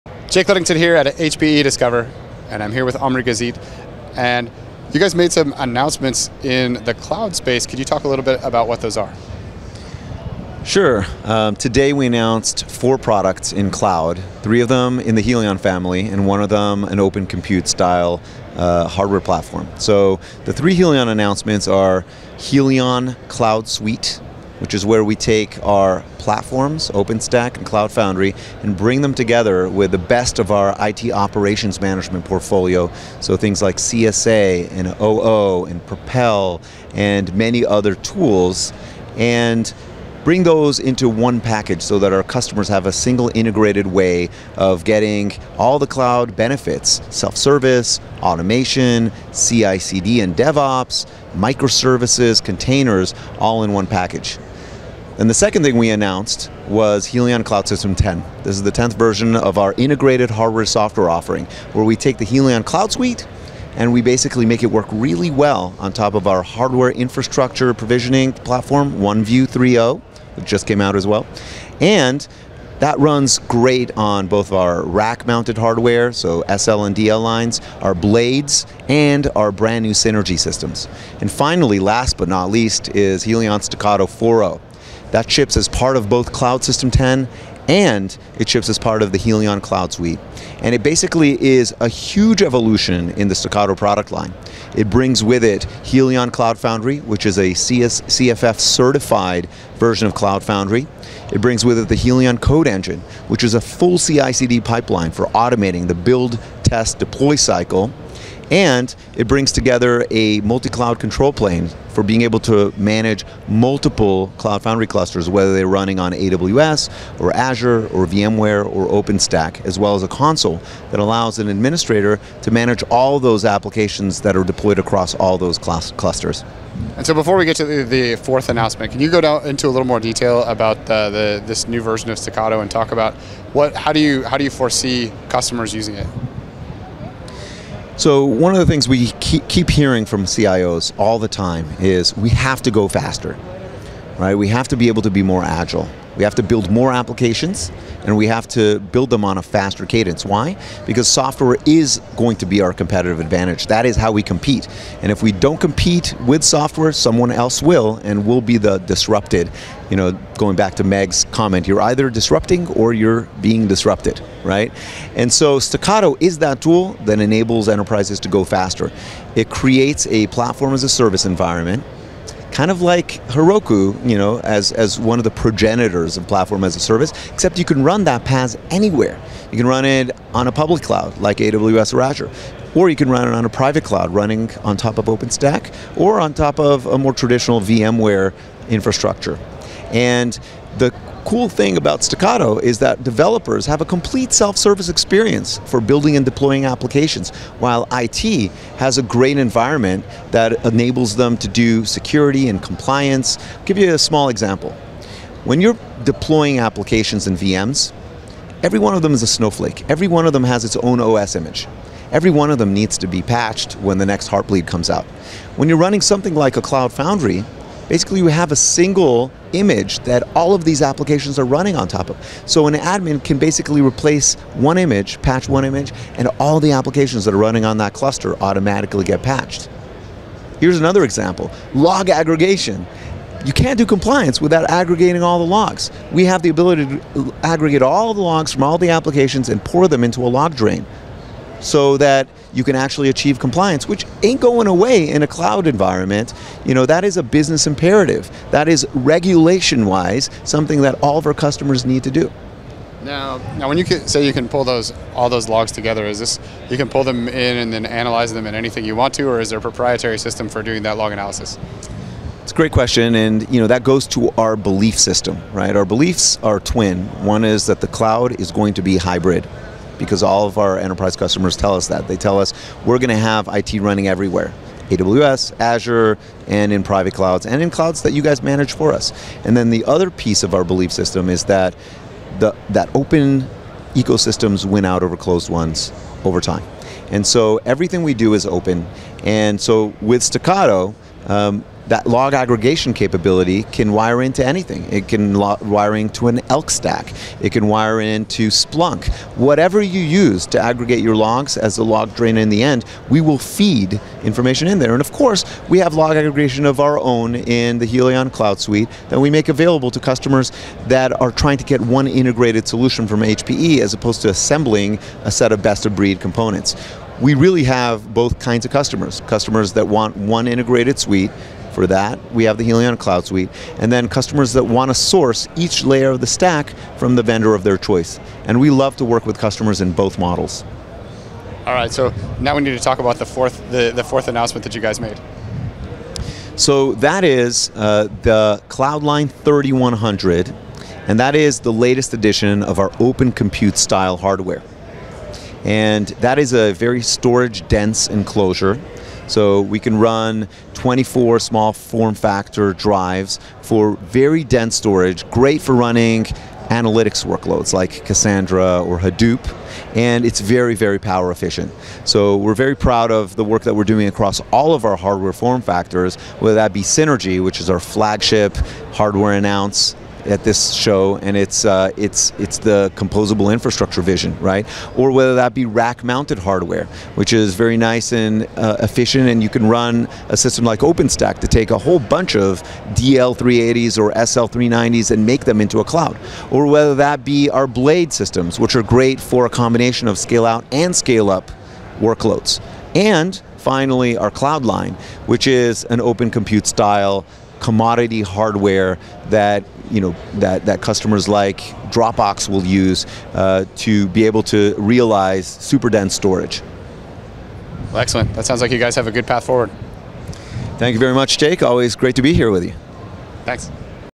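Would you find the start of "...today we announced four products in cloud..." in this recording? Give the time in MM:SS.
00:11.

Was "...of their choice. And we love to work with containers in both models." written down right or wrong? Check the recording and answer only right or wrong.
wrong.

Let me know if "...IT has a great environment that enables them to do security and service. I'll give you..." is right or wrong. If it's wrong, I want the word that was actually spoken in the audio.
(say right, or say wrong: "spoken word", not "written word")
wrong: "compliance", not "service".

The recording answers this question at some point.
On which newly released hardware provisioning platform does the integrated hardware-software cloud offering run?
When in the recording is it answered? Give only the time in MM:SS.
01:08.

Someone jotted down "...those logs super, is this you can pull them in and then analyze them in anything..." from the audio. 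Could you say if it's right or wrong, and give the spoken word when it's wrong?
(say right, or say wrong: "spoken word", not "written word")
wrong: "together", not "super".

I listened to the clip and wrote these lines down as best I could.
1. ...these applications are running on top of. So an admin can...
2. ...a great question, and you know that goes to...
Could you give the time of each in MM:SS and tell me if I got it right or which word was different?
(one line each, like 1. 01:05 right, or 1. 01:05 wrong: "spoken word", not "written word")
1. 03:40 right
2. 04:22 right.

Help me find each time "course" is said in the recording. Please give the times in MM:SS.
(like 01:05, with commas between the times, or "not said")
05:05.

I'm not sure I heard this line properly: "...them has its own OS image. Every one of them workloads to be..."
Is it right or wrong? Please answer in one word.
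wrong.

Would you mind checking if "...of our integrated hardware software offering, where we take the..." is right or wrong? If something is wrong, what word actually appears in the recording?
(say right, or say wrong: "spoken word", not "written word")
right.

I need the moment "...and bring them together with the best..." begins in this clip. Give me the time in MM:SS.
00:28.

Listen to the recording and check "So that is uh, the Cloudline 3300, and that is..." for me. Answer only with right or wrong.
wrong.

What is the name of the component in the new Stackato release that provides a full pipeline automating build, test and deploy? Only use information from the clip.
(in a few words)
Helion Code Engine.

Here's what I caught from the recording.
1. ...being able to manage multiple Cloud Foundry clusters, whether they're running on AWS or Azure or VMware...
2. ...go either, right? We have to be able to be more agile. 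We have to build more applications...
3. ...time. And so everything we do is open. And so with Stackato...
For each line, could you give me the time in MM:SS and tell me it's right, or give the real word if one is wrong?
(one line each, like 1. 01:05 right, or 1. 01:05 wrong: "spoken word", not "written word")
1. 01:52 right
2. 02:22 wrong: "faster", not "either"
3. 04:46 right.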